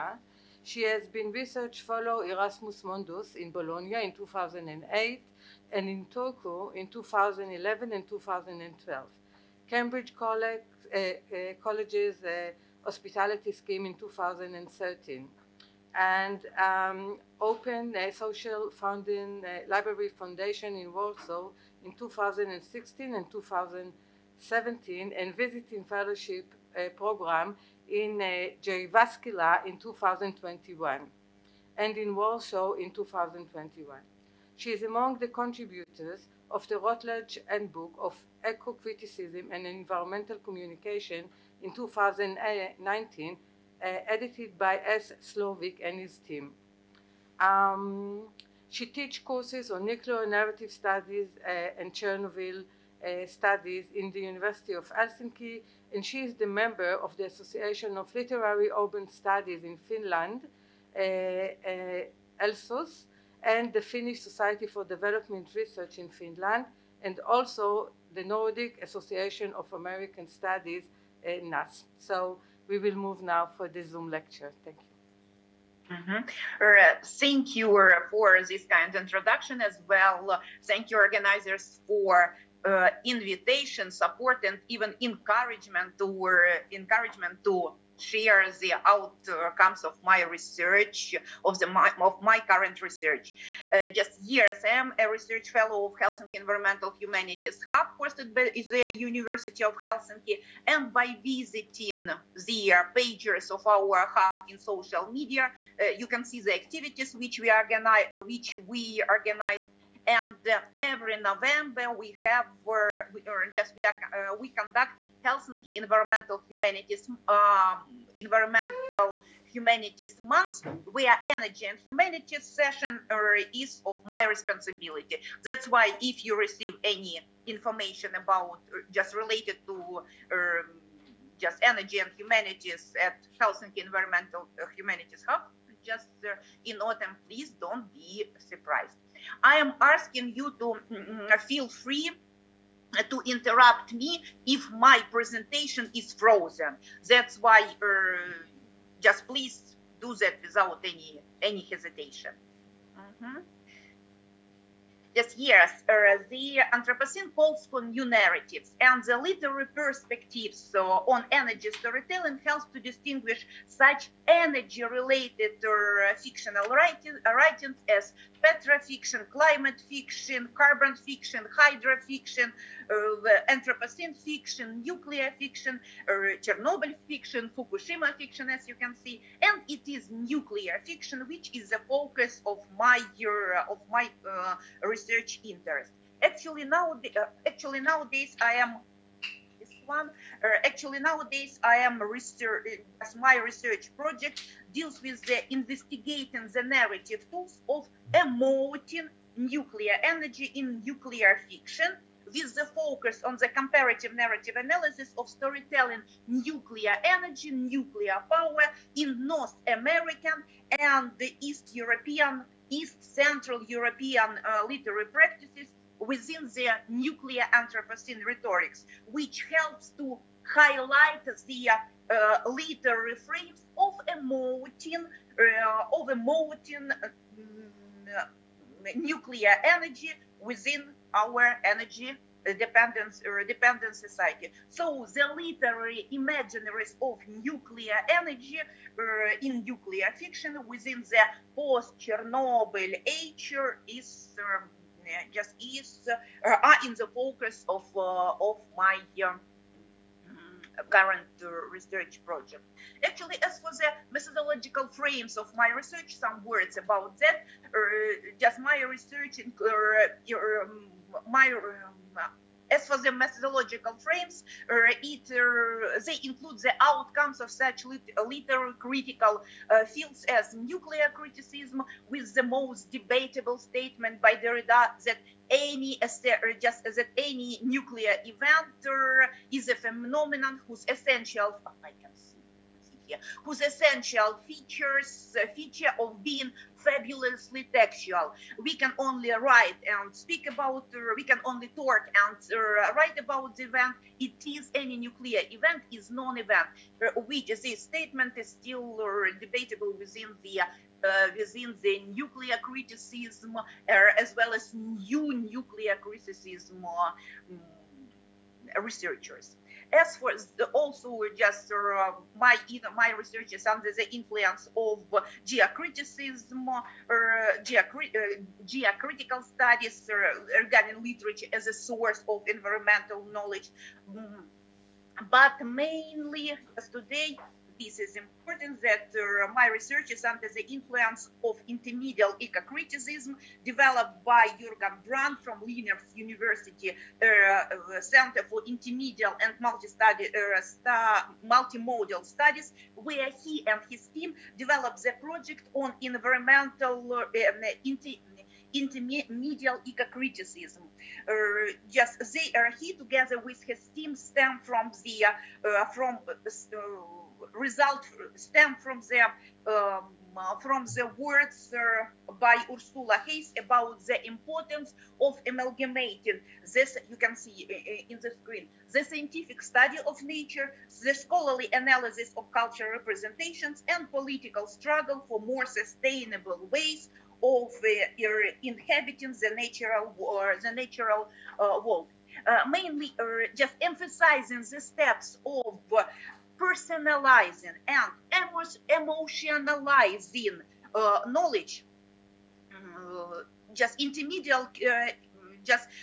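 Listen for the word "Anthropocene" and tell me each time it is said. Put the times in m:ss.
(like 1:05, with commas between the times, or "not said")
2:36, 2:53, 3:37.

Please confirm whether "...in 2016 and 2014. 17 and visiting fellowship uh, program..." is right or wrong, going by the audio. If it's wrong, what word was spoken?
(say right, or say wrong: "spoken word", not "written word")
wrong: "2017", not "2014".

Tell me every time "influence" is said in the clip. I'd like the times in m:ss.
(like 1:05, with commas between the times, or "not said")
5:14, 5:30.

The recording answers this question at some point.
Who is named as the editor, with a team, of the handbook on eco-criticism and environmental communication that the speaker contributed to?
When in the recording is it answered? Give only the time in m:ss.
0:44.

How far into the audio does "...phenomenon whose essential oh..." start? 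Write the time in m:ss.
4:39.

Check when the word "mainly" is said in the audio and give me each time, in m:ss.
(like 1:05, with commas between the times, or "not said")
5:25, 6:22.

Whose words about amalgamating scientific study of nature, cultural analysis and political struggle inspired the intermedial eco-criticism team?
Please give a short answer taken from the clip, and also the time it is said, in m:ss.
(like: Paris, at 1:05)
Ursula Heise, at 6:02.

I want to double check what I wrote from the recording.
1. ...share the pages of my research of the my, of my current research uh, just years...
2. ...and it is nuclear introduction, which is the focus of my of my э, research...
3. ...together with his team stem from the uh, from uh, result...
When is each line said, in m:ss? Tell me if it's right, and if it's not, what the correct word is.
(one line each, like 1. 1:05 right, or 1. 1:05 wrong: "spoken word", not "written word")
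1. 1:27 wrong: "outcomes", not "pages"
2. 2:59 wrong: "fiction", not "introduction"
3. 5:52 right.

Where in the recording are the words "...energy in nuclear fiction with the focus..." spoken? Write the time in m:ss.
3:20.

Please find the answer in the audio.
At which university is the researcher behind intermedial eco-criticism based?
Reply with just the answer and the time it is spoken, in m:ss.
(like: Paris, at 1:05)
Linnaeus University, at 5:35.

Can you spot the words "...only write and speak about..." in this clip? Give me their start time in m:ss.
4:48.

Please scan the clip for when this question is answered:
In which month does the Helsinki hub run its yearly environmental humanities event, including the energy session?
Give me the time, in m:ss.
1:51.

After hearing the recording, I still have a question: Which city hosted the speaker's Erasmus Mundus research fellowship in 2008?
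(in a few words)
Bologna.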